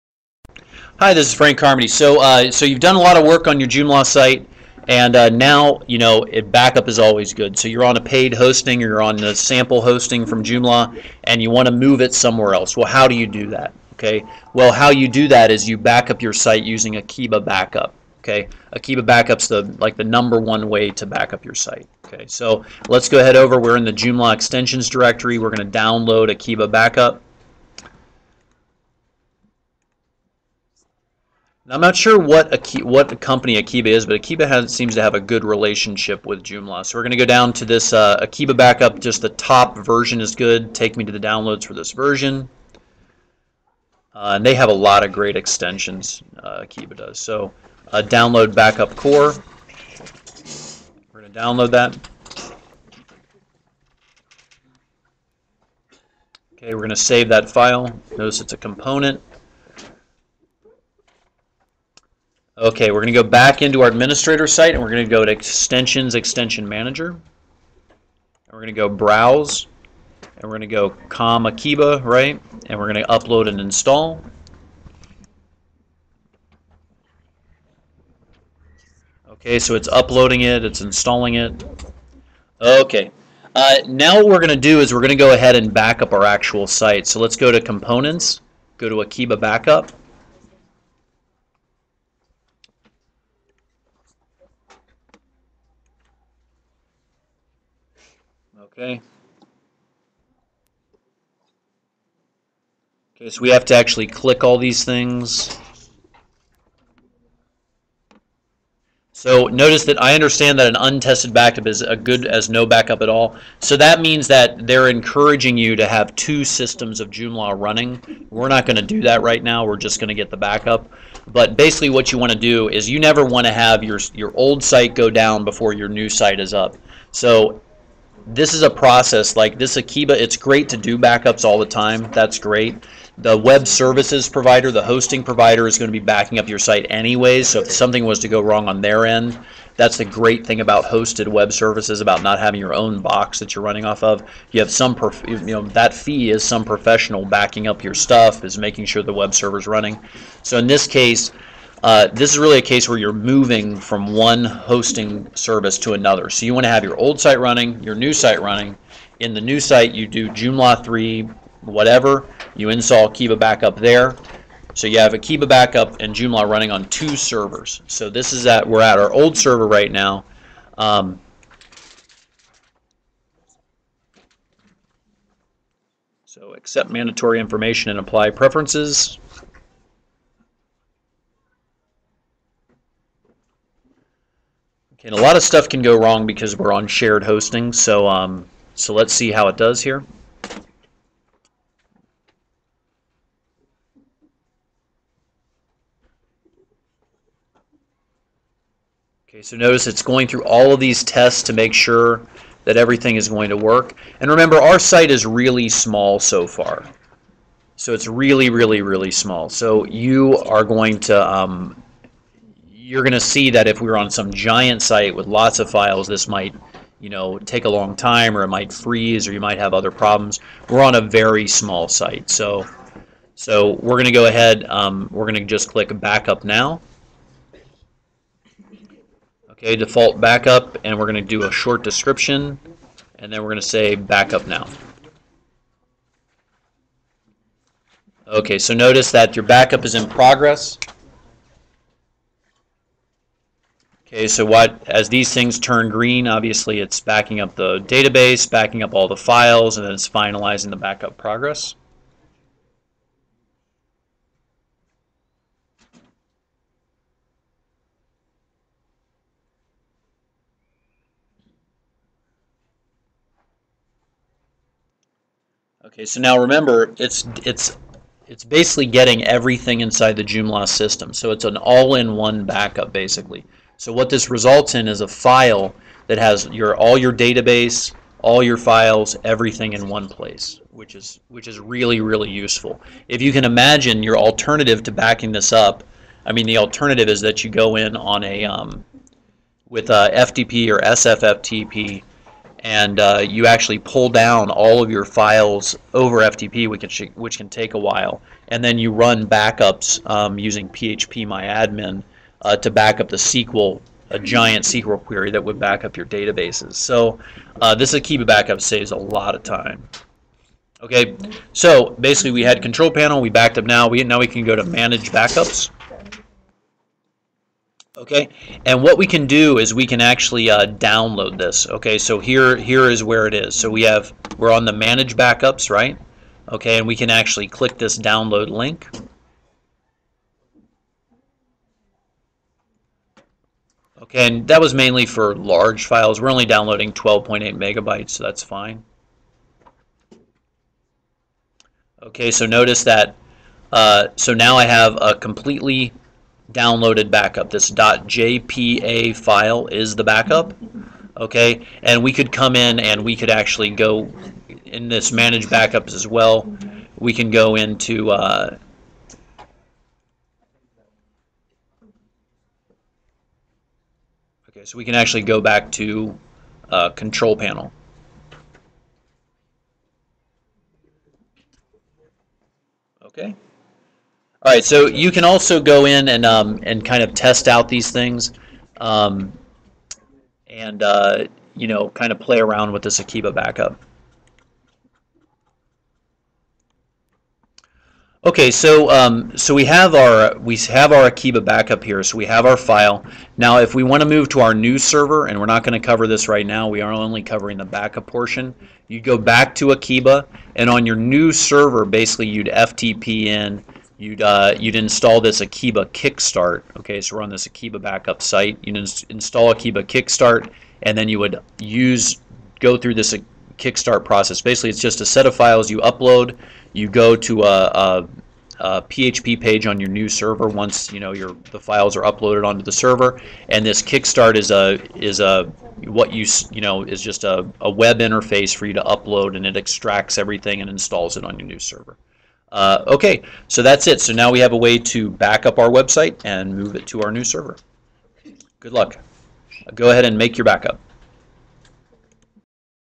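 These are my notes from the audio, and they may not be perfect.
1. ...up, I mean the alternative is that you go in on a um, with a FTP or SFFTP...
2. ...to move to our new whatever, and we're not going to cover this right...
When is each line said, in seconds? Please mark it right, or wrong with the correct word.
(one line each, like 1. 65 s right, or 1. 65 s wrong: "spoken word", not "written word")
1. 285 s right
2. 394 s wrong: "server", not "whatever".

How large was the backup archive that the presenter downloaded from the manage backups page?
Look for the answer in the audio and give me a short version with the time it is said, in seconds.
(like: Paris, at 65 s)
12.8 megabytes, at 336 s.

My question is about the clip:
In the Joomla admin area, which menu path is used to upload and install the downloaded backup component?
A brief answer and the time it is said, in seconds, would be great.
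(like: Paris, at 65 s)
Extensions, Extension Manager, at 65 s.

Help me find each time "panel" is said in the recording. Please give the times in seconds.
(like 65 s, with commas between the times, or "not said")
312 s, 367 s.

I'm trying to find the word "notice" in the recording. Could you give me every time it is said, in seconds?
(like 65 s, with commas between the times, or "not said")
58 s, 109 s, 199 s, 238 s, 342 s.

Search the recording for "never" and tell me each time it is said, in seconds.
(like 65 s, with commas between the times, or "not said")
122 s.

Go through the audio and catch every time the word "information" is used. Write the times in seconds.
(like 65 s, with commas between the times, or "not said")
177 s.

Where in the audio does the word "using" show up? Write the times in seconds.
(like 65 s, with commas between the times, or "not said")
16 s, 300 s.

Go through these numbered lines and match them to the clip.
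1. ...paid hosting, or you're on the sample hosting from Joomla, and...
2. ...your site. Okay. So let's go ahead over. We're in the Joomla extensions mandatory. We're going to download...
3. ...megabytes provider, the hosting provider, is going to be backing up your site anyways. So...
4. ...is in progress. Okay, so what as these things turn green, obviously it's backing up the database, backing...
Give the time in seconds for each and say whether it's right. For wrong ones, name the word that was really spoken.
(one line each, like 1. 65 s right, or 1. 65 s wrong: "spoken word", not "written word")
1. 8 s right
2. 21 s wrong: "directory", not "mandatory"
3. 133 s wrong: "services", not "megabytes"
4. 239 s right.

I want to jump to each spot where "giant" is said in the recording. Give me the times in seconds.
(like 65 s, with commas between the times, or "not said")
214 s, 304 s.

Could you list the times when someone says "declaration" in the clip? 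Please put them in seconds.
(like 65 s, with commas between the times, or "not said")
not said.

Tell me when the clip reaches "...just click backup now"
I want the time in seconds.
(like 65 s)
225 s.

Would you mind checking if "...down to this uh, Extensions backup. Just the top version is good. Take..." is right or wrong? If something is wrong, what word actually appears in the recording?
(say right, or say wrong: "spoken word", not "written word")
wrong: "Akeeba", not "Extensions".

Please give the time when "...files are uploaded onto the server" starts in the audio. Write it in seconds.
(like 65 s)
421 s.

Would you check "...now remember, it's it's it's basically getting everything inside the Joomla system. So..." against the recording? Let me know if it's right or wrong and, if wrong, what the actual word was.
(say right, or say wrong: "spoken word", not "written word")
right.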